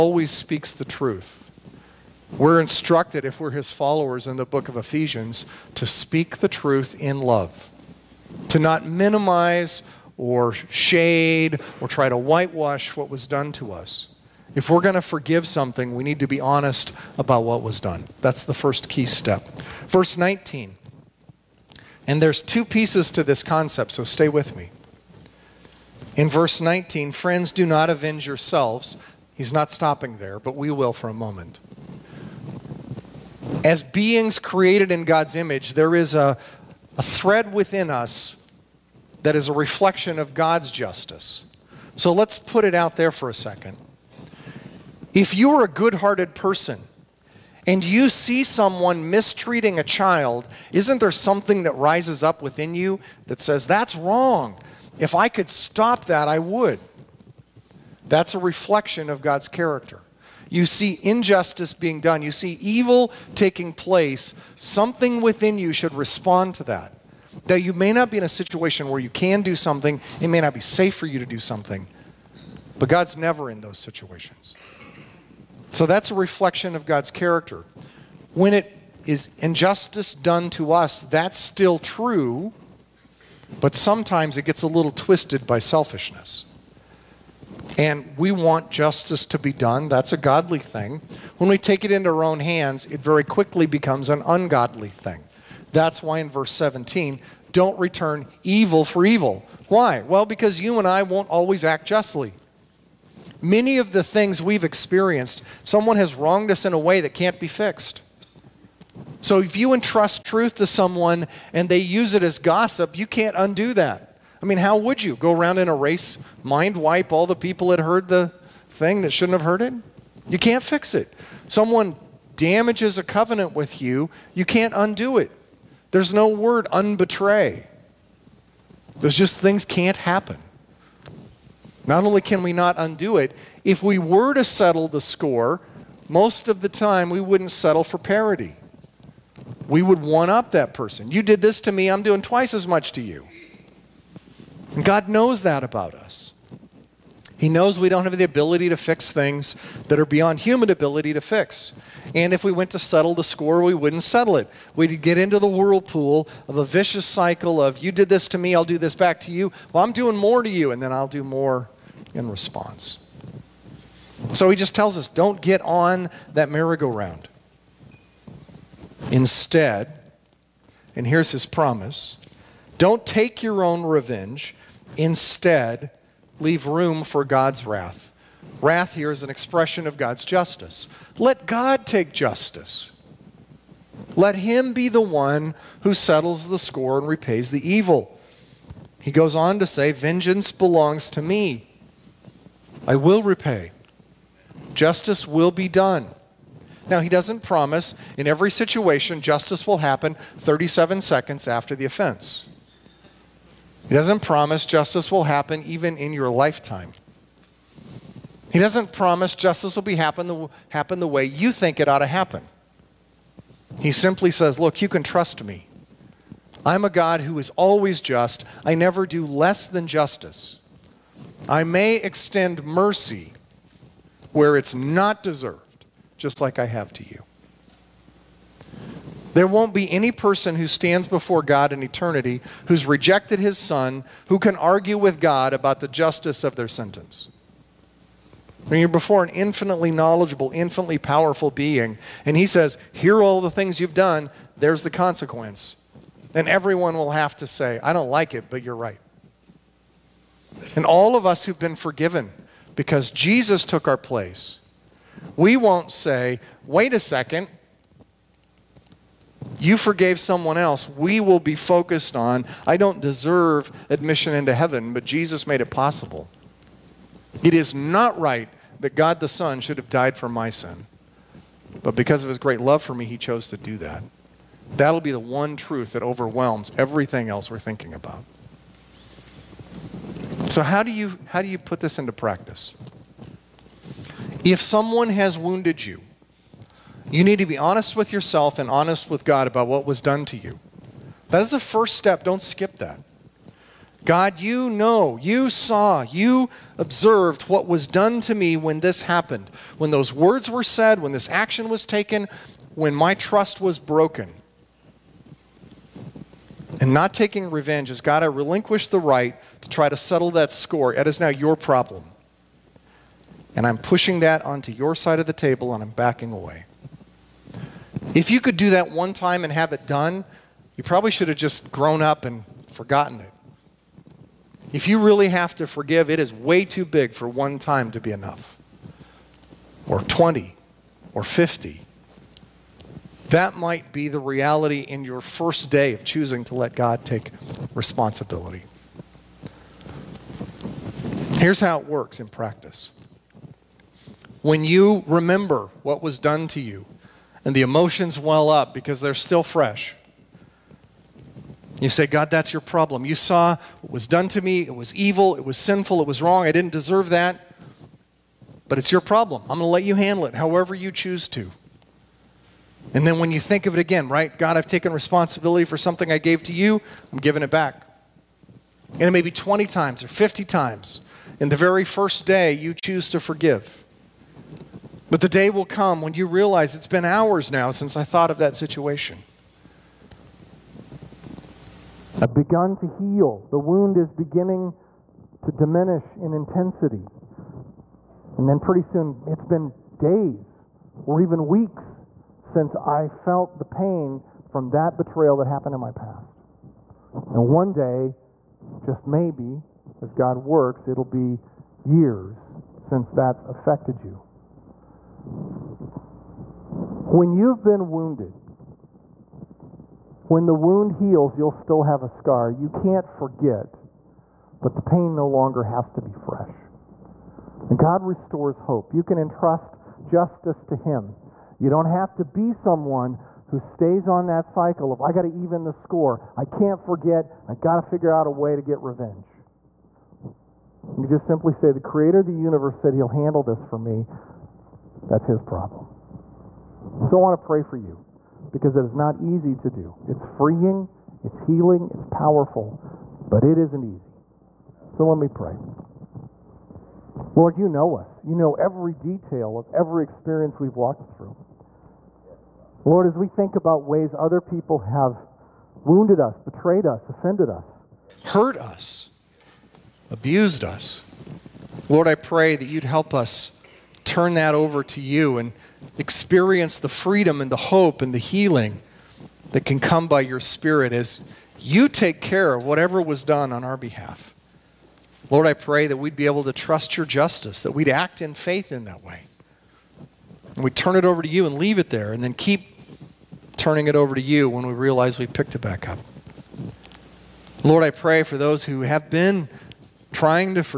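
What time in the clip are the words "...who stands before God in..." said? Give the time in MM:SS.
03:50.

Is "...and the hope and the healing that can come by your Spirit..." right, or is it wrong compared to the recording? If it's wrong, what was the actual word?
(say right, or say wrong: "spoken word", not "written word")
right.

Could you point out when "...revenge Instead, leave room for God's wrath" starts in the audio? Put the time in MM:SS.
02:53.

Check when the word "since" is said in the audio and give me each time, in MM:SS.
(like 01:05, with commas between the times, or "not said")
06:17, 06:32, 06:42.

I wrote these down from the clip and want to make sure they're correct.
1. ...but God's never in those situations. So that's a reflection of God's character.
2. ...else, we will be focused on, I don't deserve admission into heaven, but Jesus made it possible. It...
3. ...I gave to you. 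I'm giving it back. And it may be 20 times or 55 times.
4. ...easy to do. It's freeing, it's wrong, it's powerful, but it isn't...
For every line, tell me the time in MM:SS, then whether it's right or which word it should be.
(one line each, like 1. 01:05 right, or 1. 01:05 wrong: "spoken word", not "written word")
1. 01:12 right
2. 04:20 right
3. 06:06 wrong: "50", not "55"
4. 07:19 wrong: "healing", not "wrong".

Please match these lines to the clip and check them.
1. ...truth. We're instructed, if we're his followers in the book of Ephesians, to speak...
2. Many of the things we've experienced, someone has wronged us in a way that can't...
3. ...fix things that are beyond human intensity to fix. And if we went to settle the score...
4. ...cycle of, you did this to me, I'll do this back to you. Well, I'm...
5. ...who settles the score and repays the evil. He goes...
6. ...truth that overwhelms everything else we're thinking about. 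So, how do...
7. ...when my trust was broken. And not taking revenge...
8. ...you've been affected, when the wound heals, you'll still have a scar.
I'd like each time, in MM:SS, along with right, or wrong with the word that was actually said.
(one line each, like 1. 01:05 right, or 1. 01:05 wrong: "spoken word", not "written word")
1. 00:00 right
2. 01:43 right
3. 02:28 wrong: "ability", not "intensity"
4. 02:37 right
5. 03:05 right
6. 04:35 right
7. 05:02 right
8. 06:47 wrong: "wounded", not "affected".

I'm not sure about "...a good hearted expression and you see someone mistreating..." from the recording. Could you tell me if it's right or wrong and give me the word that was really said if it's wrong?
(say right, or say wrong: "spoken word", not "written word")
wrong: "person", not "expression".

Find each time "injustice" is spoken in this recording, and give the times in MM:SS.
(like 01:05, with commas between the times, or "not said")
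01:01, 01:19.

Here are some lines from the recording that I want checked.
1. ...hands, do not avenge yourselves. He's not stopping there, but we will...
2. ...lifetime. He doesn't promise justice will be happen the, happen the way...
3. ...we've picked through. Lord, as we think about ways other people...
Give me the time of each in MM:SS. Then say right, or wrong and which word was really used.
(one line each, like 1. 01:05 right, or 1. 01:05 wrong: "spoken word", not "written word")
1. 00:27 wrong: "friends", not "hands"
2. 03:26 right
3. 07:30 wrong: "walked", not "picked".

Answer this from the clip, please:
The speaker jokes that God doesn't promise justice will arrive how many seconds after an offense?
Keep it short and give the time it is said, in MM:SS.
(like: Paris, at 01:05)
37, at 03:20.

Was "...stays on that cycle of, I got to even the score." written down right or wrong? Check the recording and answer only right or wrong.
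right.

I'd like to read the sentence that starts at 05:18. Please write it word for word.
If you could do that one time and have it done, you probably should have just grown up and forgotten it.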